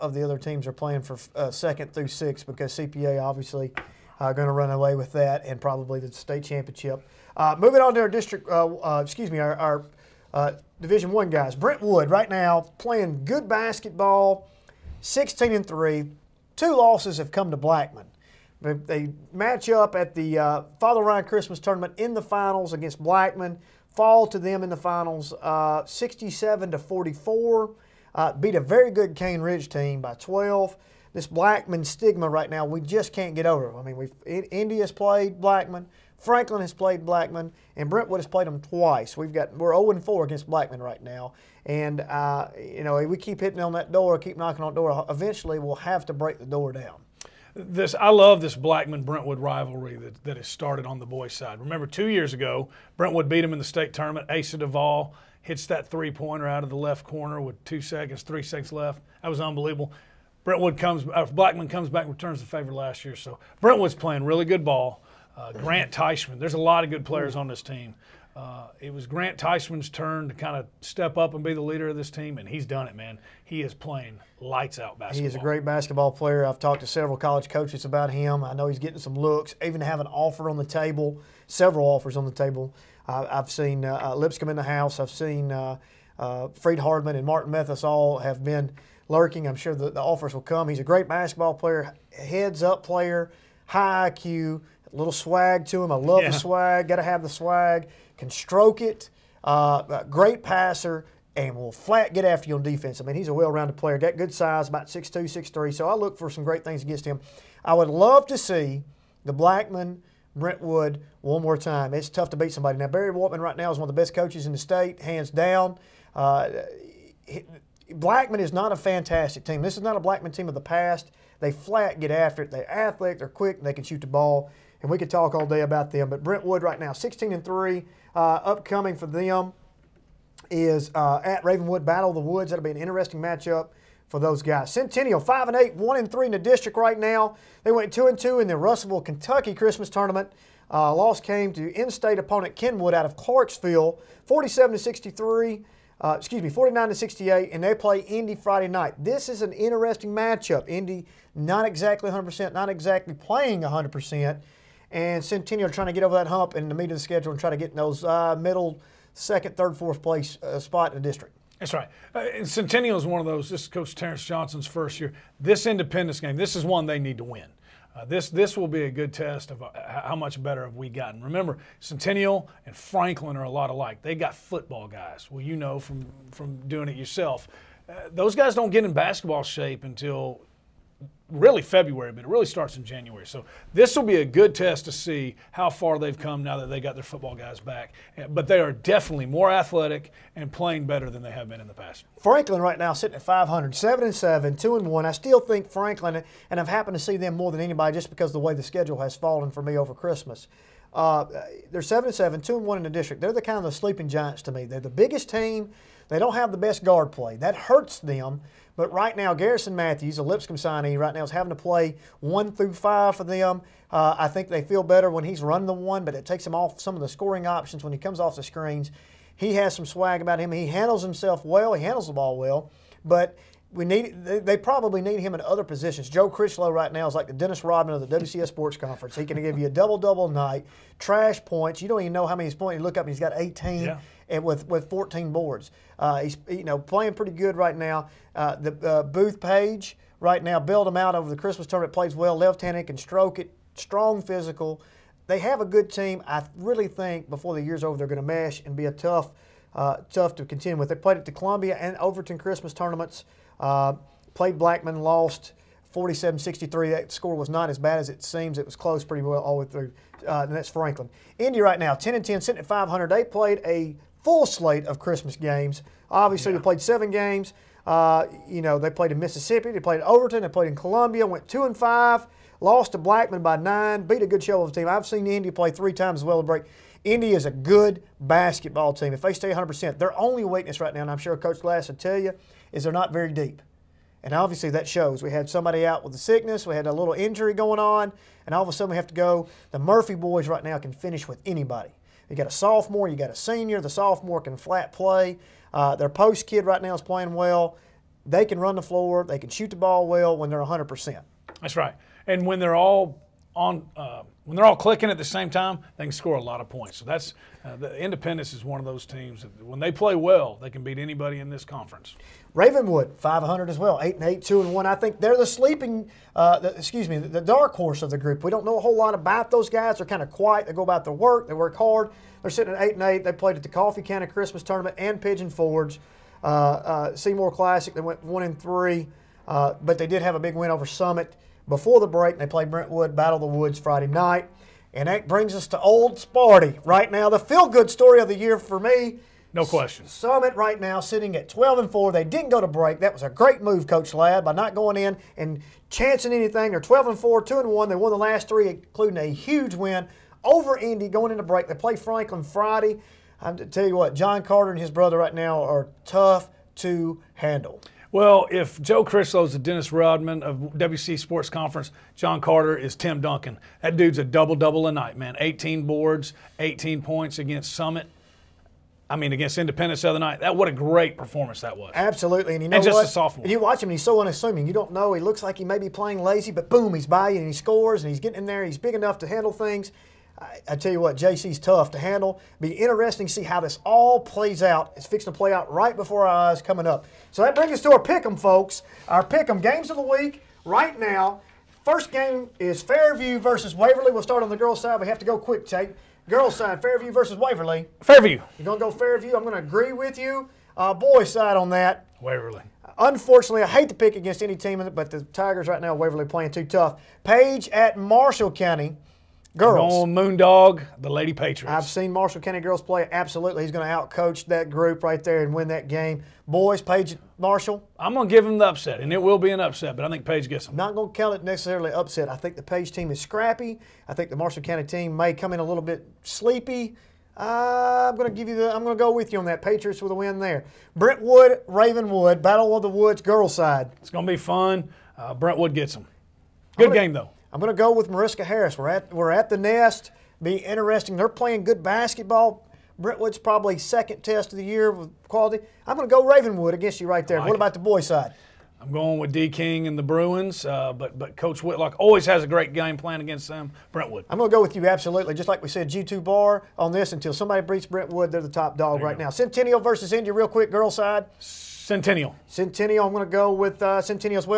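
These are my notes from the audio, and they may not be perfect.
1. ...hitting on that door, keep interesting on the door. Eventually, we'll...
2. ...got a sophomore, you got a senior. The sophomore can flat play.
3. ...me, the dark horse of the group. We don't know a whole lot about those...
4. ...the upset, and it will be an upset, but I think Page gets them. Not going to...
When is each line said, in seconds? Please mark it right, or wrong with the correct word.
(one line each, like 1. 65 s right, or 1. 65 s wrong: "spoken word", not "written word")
1. 43 s wrong: "knocking", not "interesting"
2. 292 s right
3. 317 s right
4. 418 s right.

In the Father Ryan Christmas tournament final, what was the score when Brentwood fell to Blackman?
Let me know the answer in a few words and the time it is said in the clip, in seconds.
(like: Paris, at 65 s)
67-44, at 25 s.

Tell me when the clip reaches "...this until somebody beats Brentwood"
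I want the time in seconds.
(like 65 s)
456 s.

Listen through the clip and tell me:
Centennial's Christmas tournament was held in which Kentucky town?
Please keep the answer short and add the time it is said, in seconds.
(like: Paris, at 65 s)
Russellville, at 138 s.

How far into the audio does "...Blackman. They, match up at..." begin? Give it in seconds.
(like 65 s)
17 s.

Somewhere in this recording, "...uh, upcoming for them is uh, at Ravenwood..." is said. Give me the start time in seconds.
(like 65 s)
128 s.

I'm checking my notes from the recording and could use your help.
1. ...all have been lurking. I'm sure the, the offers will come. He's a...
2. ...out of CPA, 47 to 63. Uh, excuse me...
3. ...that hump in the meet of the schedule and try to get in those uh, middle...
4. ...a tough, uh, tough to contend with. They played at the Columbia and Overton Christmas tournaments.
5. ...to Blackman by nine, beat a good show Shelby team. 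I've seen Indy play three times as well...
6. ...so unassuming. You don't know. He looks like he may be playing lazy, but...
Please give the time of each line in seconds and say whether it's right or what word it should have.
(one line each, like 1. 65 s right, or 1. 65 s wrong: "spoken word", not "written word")
1. 87 s right
2. 142 s wrong: "Clarksville", not "CPA"
3. 156 s right
4. 248 s right
5. 272 s right
6. 374 s right.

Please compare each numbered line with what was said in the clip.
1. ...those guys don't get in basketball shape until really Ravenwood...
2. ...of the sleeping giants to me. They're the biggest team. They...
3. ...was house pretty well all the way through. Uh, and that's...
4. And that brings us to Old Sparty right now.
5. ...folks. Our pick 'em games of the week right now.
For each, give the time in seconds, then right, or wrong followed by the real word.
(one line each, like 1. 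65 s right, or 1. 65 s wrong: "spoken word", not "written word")
1. 178 s wrong: "February", not "Ravenwood"
2. 203 s right
3. 258 s wrong: "close", not "house"
4. 334 s right
5. 388 s right.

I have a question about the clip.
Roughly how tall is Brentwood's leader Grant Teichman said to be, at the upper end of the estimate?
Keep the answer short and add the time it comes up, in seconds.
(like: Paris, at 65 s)
6'3", at 105 s.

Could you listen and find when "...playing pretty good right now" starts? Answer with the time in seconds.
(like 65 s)
236 s.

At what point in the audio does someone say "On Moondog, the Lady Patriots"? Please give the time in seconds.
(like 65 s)
409 s.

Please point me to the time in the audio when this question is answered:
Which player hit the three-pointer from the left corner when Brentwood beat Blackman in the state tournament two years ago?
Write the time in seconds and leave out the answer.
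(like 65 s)
54 s.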